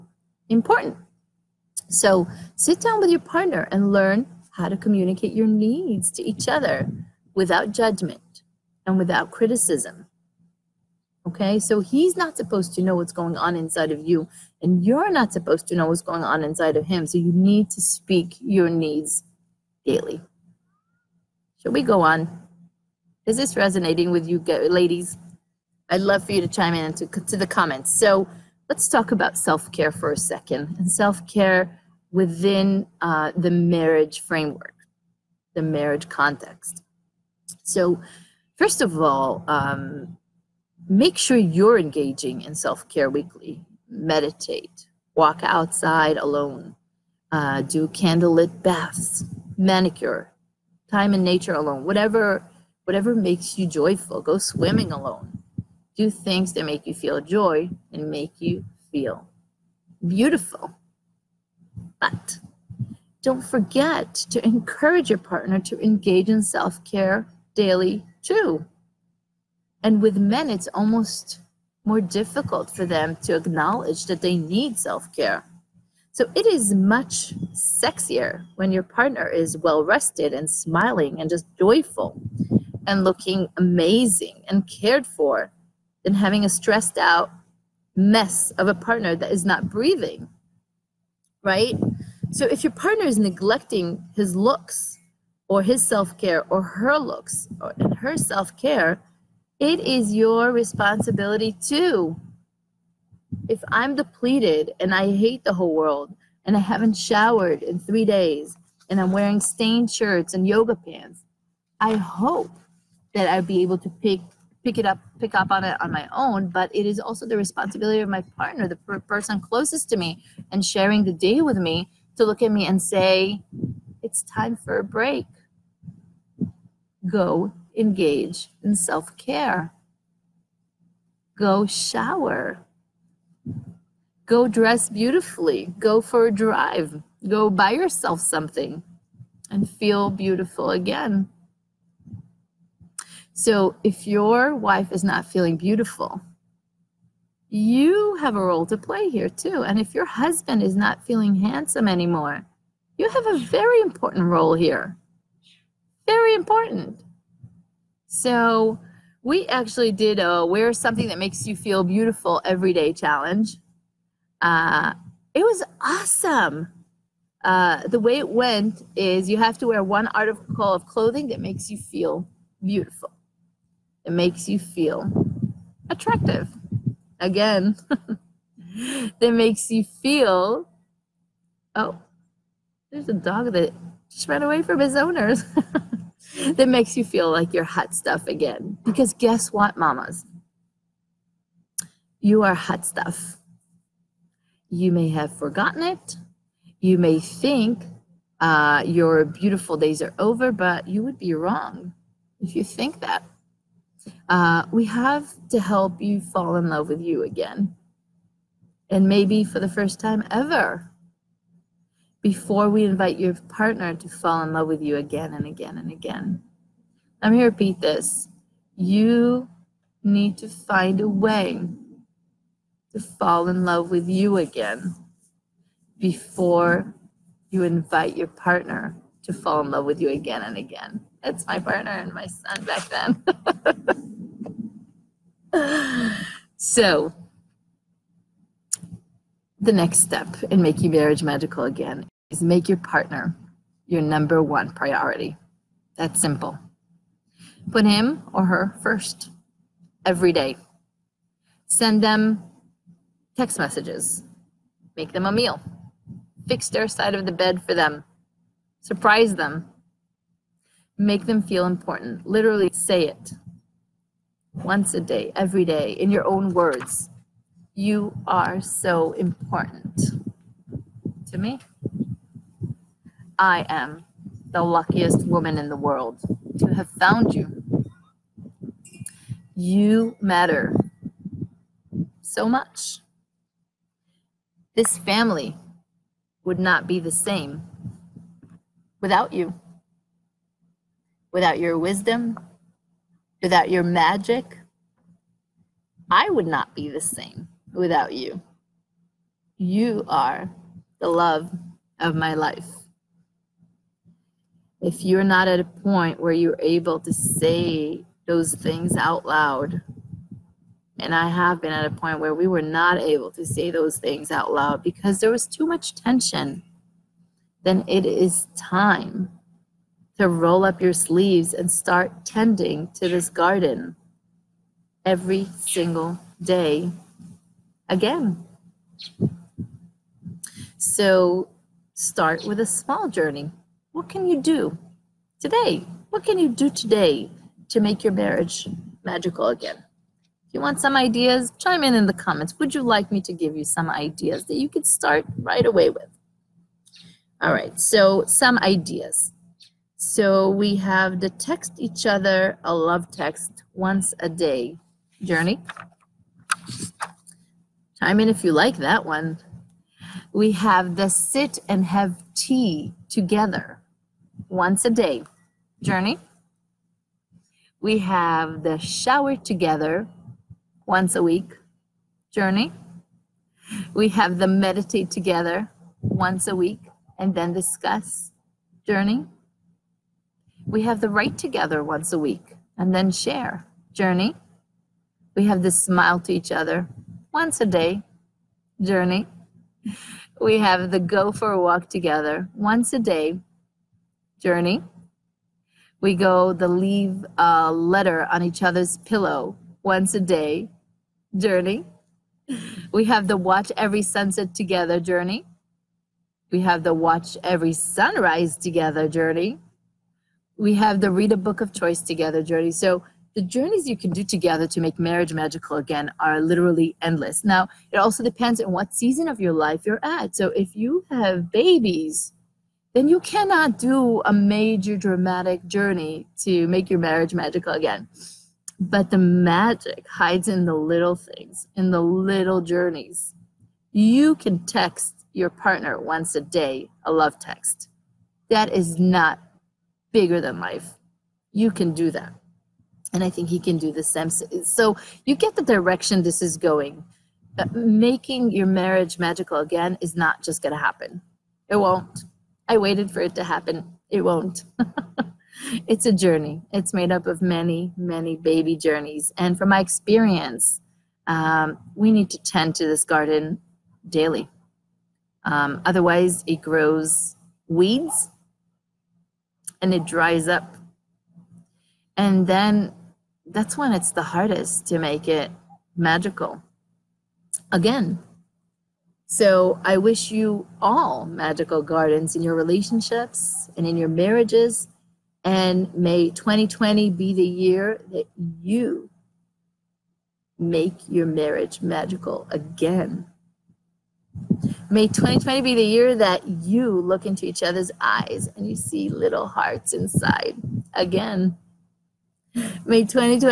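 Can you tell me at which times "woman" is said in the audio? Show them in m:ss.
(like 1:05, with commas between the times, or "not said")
4:35.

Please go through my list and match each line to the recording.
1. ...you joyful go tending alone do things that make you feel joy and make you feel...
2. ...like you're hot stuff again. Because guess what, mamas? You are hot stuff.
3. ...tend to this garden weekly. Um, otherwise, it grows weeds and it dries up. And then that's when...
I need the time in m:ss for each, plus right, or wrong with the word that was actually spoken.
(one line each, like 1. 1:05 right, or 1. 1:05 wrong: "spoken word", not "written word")
1. 0:53 wrong: "swimming", not "tending"
2. 3:07 right
3. 7:42 wrong: "daily", not "weekly".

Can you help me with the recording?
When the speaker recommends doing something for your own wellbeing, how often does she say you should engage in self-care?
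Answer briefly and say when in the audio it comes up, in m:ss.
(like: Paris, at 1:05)
weekly, at 0:43.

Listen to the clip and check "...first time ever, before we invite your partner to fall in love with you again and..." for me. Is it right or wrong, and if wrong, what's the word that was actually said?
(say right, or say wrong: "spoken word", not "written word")
right.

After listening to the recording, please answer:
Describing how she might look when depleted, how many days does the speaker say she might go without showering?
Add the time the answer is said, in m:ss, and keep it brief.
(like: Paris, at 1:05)
3, at 1:47.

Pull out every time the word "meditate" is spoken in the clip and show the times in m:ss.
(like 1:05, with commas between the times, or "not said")
0:43, 6:14.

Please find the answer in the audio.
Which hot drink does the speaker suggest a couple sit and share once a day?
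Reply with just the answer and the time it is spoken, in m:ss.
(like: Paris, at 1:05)
tea, at 6:02.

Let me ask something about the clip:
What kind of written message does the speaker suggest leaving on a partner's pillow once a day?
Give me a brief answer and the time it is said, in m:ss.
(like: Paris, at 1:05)
a letter, at 6:37.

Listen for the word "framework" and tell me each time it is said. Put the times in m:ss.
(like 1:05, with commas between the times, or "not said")
0:34.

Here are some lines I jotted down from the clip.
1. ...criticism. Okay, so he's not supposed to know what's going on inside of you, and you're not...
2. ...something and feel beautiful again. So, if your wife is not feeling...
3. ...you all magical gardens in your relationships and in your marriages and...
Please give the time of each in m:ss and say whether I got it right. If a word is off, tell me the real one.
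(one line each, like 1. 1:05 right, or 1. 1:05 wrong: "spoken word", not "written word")
1. 0:09 right
2. 2:18 right
3. 8:00 right.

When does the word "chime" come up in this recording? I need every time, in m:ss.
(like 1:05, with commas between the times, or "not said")
0:26, 5:41, 5:57.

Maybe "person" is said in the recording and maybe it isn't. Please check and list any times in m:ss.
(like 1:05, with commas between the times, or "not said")
1:58.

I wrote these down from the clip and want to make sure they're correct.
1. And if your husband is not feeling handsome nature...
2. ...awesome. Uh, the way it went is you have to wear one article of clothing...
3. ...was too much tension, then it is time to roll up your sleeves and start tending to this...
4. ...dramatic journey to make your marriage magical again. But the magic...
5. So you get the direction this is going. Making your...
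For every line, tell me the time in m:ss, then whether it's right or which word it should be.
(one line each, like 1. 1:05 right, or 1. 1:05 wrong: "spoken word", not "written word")
1. 2:29 wrong: "anymore", not "nature"
2. 2:45 right
3. 5:15 right
4. 7:04 right
5. 7:24 right.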